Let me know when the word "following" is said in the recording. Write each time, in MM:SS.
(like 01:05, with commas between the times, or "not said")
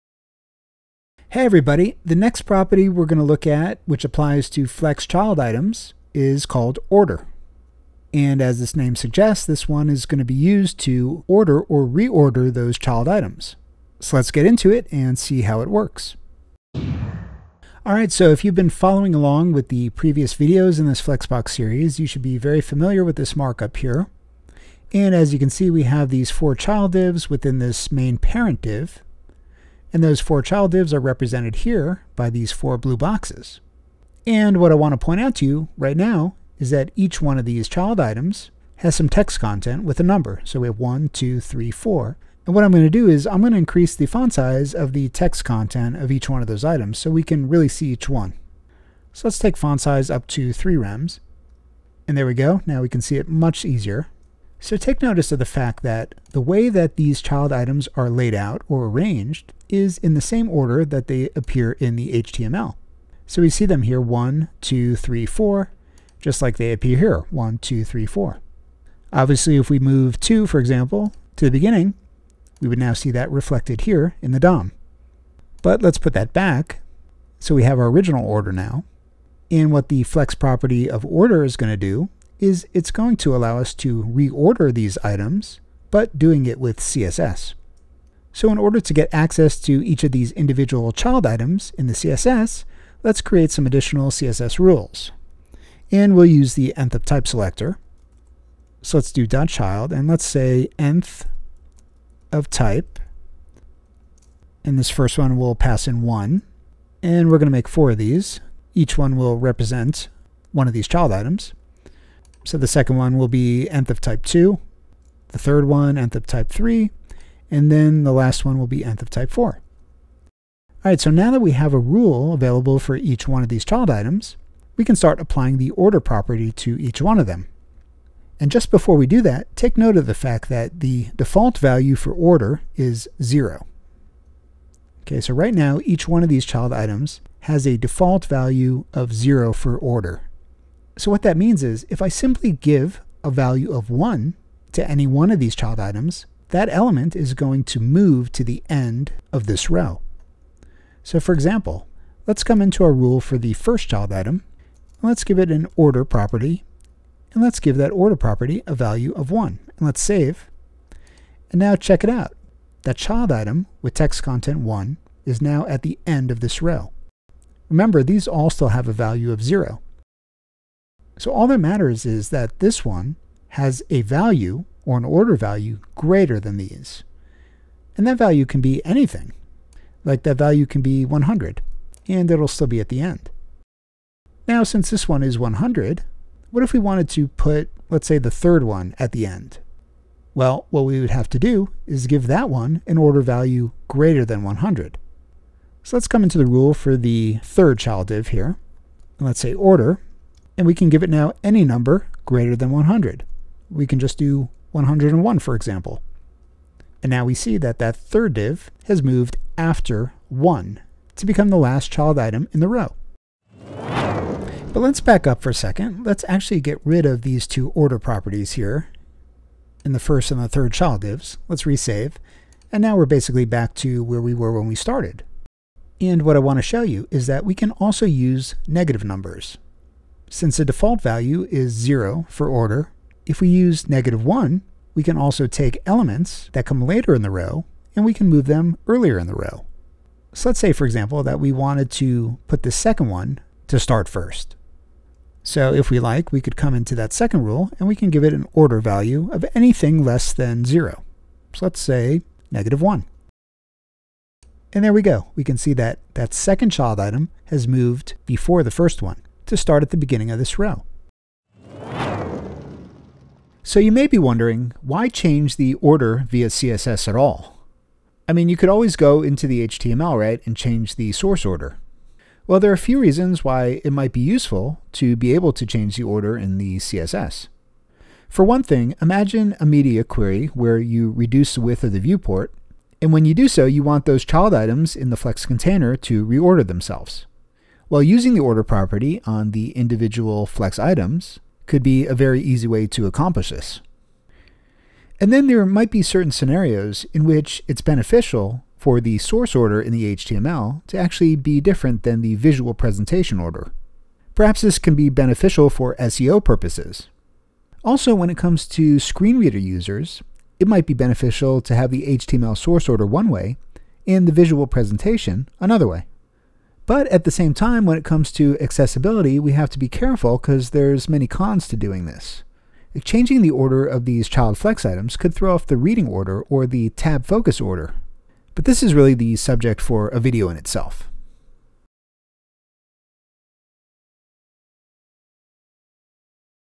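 00:18.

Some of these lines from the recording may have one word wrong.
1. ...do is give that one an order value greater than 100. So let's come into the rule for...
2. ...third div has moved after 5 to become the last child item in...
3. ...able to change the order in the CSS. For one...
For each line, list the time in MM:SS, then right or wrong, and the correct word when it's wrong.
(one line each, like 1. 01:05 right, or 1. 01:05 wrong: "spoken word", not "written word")
1. 03:11 right
2. 03:27 wrong: "1", not "5"
3. 04:35 right.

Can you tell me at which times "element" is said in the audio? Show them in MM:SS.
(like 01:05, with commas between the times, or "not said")
02:26, 03:55.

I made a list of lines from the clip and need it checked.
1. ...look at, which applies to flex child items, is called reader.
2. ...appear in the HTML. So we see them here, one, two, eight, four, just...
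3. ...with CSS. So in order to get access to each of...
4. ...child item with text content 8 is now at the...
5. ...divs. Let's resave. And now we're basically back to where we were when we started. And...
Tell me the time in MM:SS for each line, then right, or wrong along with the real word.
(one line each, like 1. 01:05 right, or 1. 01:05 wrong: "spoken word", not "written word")
1. 00:03 wrong: "order", not "reader"
2. 01:01 wrong: "three", not "eight"
3. 01:26 right
4. 02:42 wrong: "1", not "8"
5. 03:41 right.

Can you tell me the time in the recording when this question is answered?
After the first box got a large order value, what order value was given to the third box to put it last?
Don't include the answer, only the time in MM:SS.
03:24.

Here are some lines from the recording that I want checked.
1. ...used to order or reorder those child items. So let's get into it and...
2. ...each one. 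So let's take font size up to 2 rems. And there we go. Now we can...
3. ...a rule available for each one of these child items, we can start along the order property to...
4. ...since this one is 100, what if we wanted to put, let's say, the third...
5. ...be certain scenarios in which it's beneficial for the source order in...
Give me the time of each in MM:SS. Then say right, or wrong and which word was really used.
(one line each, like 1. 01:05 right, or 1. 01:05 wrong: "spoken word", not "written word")
1. 00:10 right
2. 00:47 wrong: "3", not "2"
3. 02:01 wrong: "applying", not "along"
4. 03:04 right
5. 04:55 right.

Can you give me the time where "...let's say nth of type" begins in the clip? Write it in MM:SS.
01:40.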